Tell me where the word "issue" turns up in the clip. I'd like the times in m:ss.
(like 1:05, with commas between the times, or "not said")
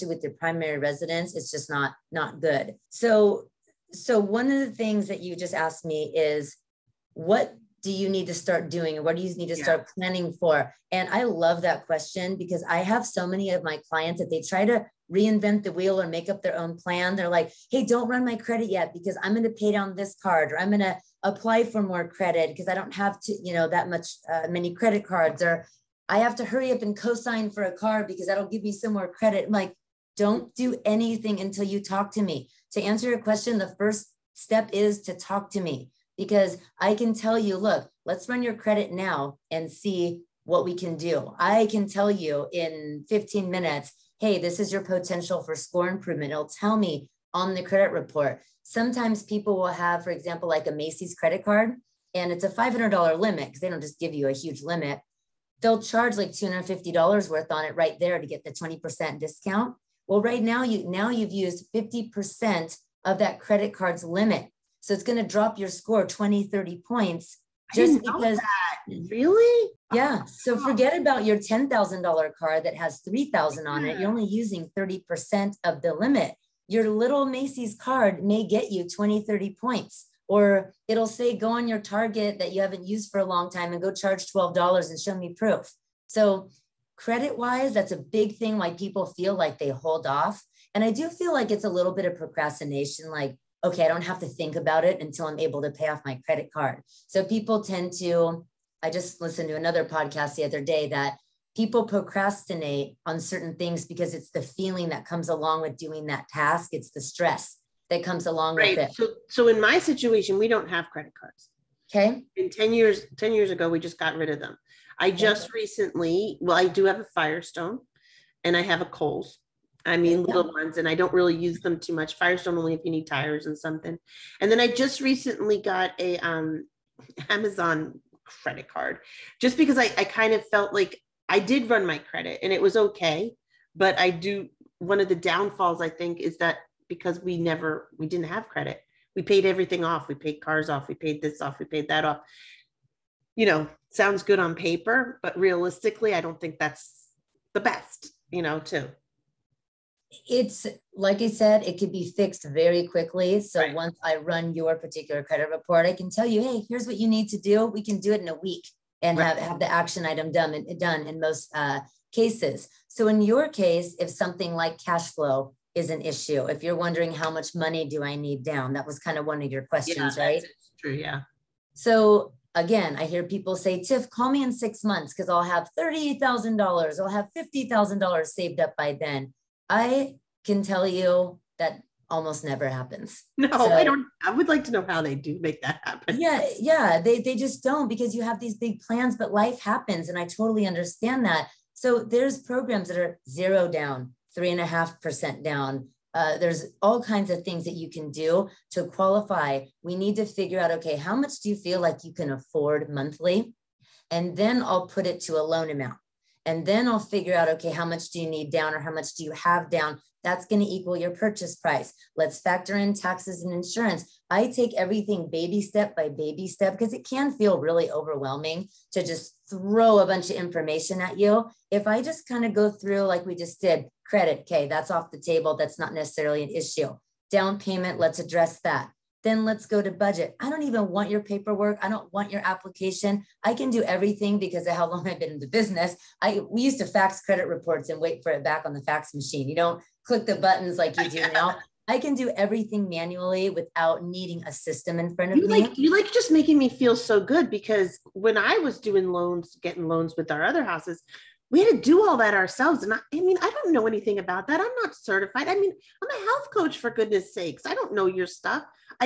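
2:46, 3:46.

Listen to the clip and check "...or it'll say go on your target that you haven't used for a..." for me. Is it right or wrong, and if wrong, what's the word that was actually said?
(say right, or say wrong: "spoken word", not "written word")
right.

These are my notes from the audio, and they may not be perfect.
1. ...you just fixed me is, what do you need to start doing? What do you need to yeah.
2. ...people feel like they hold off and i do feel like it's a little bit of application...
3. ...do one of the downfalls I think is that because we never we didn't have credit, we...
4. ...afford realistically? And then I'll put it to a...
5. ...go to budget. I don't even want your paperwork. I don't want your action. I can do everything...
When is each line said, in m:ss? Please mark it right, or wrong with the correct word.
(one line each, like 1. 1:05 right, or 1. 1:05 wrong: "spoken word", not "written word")
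1. 0:05 wrong: "asked", not "fixed"
2. 1:28 wrong: "procrastination", not "application"
3. 2:14 right
4. 3:22 wrong: "monthly", not "realistically"
5. 3:49 wrong: "application", not "action".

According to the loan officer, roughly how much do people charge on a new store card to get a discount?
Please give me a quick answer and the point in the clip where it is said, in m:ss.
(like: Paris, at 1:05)
$250, at 0:56.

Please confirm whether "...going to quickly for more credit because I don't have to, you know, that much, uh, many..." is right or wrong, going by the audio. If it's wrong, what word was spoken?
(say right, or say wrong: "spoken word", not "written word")
wrong: "apply", not "quickly".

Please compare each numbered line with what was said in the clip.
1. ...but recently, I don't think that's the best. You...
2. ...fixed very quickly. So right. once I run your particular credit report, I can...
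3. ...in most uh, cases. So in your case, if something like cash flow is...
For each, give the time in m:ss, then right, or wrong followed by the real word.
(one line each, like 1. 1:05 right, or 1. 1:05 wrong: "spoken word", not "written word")
1. 2:25 wrong: "realistically", not "recently"
2. 2:32 right
3. 2:41 right.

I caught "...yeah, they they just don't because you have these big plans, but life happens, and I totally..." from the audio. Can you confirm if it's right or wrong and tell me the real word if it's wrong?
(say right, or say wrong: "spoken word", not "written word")
right.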